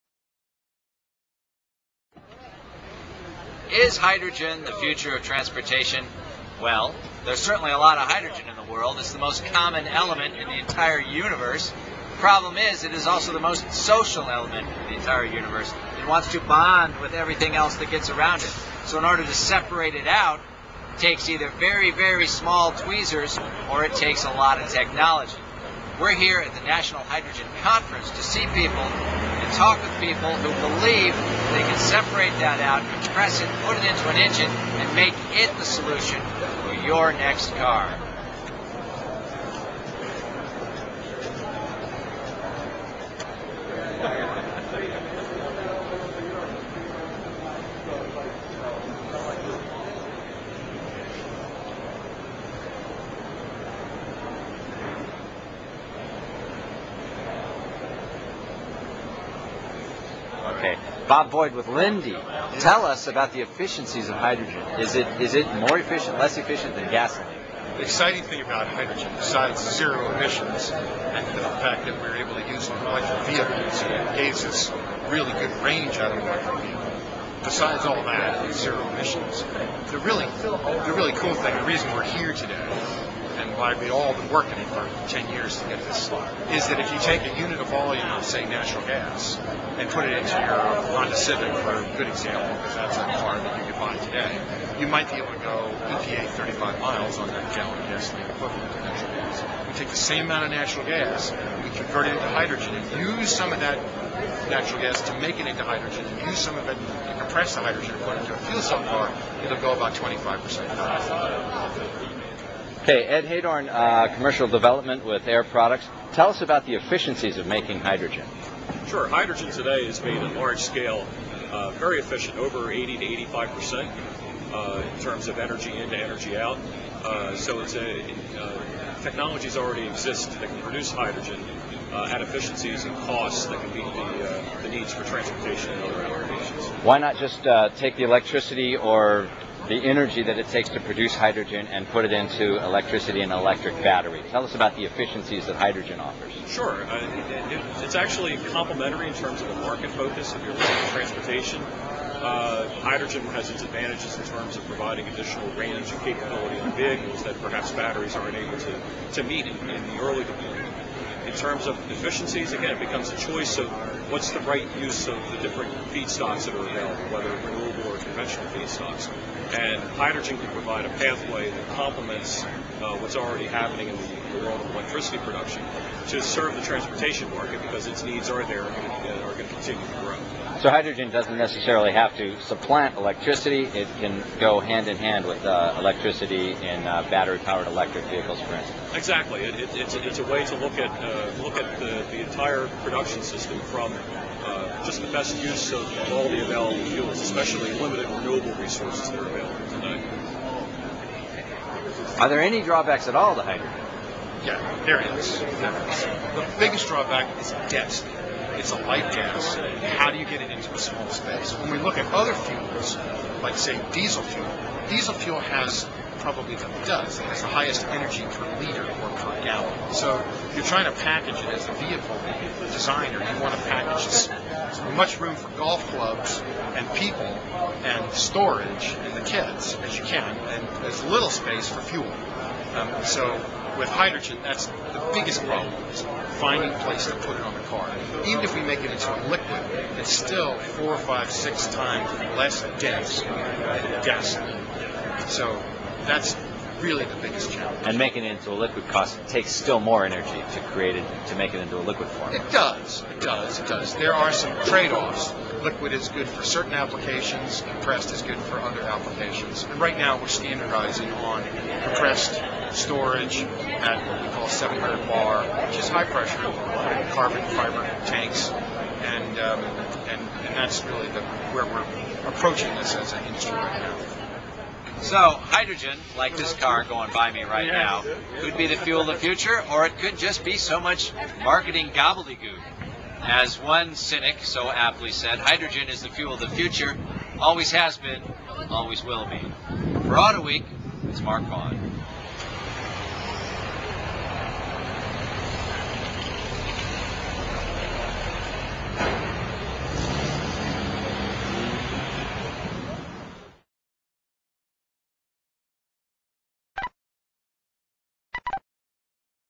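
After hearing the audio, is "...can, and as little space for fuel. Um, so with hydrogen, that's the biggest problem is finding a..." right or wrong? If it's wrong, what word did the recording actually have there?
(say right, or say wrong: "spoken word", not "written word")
right.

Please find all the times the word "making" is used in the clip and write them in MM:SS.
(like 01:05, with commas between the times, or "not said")
01:57, 04:07.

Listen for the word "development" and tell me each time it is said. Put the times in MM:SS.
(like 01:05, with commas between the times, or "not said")
01:54.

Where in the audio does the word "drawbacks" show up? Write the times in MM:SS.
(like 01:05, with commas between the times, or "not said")
03:22, 03:26.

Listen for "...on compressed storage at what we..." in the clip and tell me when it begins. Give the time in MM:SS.
04:21.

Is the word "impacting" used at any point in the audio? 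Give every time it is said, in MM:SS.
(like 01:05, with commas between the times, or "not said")
not said.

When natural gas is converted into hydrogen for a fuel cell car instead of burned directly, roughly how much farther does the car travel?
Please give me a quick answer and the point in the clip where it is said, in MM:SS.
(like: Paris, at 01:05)
25%, at 01:49.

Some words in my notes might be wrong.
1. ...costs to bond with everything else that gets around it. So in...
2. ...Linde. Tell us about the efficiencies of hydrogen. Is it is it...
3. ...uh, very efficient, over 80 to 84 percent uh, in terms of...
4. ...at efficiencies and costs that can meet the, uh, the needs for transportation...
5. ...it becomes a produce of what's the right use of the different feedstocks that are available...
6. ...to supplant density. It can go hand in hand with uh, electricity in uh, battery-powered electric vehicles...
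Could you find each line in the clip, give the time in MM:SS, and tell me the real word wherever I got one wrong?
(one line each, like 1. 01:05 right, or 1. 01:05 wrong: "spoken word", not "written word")
1. 00:16 wrong: "wants", not "costs"
2. 01:01 right
3. 02:01 wrong: "85", not "84"
4. 02:12 right
5. 02:42 wrong: "choice", not "produce"
6. 03:02 wrong: "electricity", not "density".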